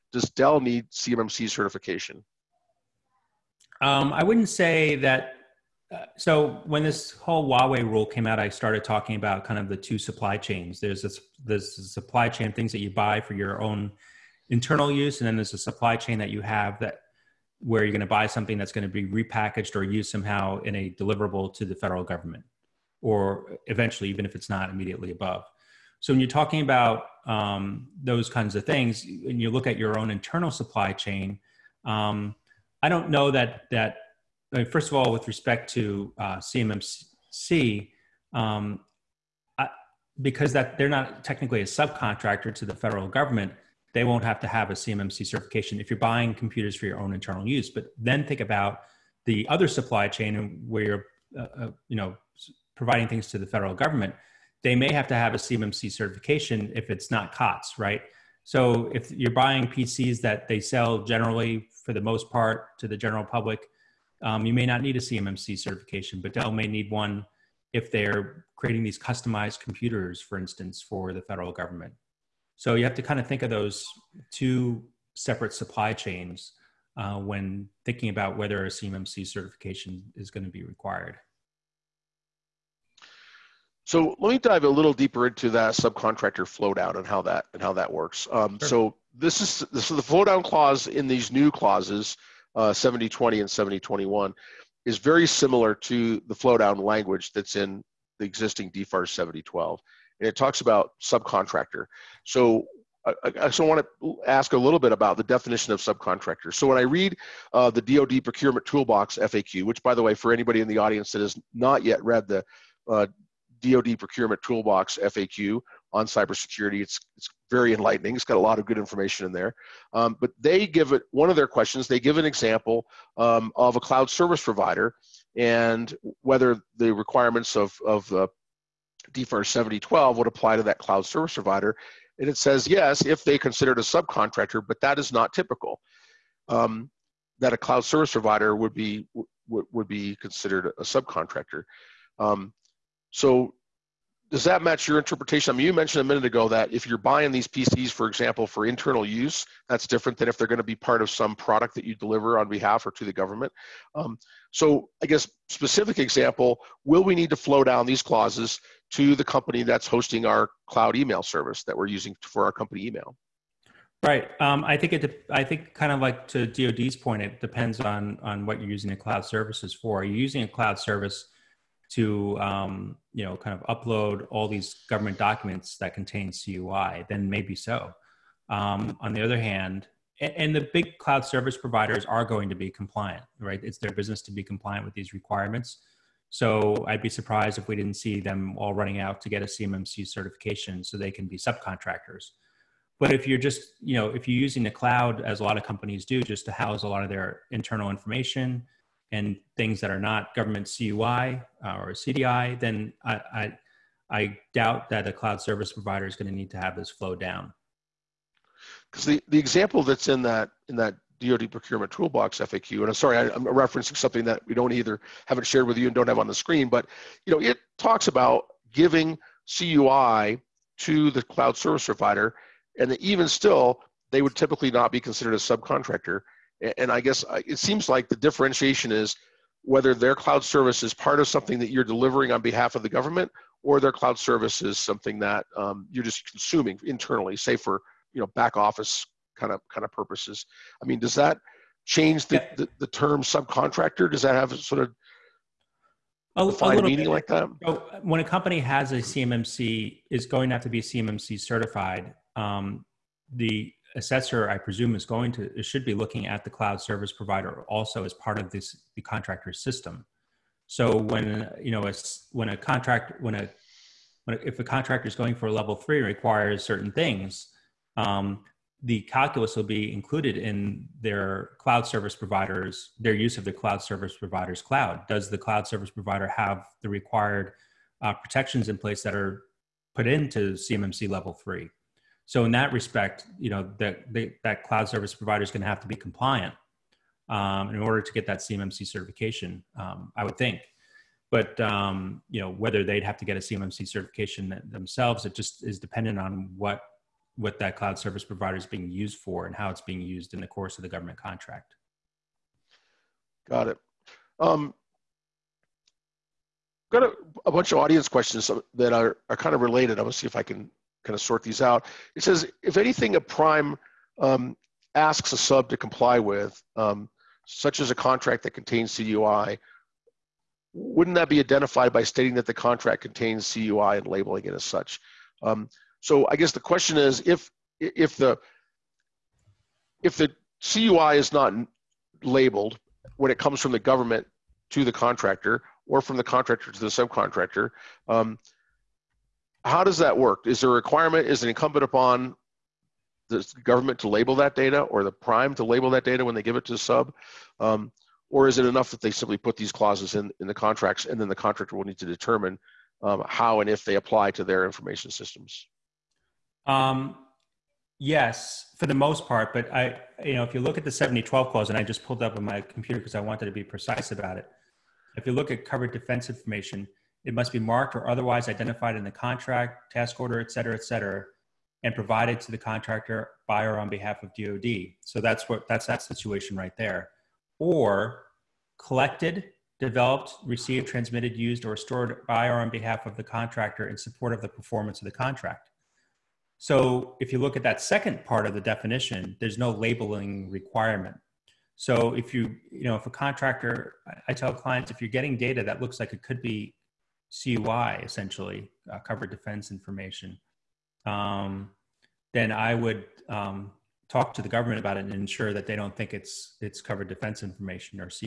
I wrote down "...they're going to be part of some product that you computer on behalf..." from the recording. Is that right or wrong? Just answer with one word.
wrong.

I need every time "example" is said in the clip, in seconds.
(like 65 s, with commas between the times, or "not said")
122 s, 148 s, 155 s, 209 s.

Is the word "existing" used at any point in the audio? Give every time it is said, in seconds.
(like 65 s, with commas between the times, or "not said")
98 s.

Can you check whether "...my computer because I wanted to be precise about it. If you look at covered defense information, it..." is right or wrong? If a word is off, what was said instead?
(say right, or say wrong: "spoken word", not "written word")
right.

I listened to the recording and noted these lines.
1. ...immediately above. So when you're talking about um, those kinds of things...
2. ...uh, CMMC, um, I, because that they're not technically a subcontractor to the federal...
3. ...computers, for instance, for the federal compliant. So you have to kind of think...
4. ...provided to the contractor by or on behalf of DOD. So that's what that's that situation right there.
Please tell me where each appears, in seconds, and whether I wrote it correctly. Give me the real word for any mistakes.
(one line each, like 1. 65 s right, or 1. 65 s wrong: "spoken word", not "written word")
1. 24 s right
2. 36 s right
3. 69 s wrong: "government", not "compliant"
4. 371 s right.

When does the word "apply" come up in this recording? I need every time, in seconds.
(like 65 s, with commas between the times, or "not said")
130 s, 353 s.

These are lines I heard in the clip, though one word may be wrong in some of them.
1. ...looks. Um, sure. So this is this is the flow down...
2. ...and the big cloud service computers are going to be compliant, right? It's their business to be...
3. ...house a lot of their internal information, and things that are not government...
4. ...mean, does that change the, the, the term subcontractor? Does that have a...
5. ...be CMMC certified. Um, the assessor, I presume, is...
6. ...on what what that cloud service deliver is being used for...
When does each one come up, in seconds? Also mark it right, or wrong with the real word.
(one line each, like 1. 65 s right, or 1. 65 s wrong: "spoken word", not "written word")
1. 87 s wrong: "works", not "looks"
2. 180 s wrong: "providers", not "computers"
3. 196 s right
4. 240 s right
5. 250 s right
6. 296 s wrong: "provider", not "deliver".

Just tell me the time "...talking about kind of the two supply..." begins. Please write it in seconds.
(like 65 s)
8 s.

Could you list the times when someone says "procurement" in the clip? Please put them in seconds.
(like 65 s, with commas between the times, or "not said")
108 s, 113 s, 211 s.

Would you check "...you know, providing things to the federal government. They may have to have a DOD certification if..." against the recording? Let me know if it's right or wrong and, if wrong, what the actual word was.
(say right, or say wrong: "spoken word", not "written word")
wrong: "CMMC", not "DOD".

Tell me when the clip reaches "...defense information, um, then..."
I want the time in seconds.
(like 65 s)
399 s.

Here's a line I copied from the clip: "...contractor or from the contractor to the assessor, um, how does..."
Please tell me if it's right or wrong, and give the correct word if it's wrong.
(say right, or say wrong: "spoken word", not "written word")
wrong: "subcontractor", not "assessor".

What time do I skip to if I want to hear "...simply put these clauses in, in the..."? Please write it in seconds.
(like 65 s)
349 s.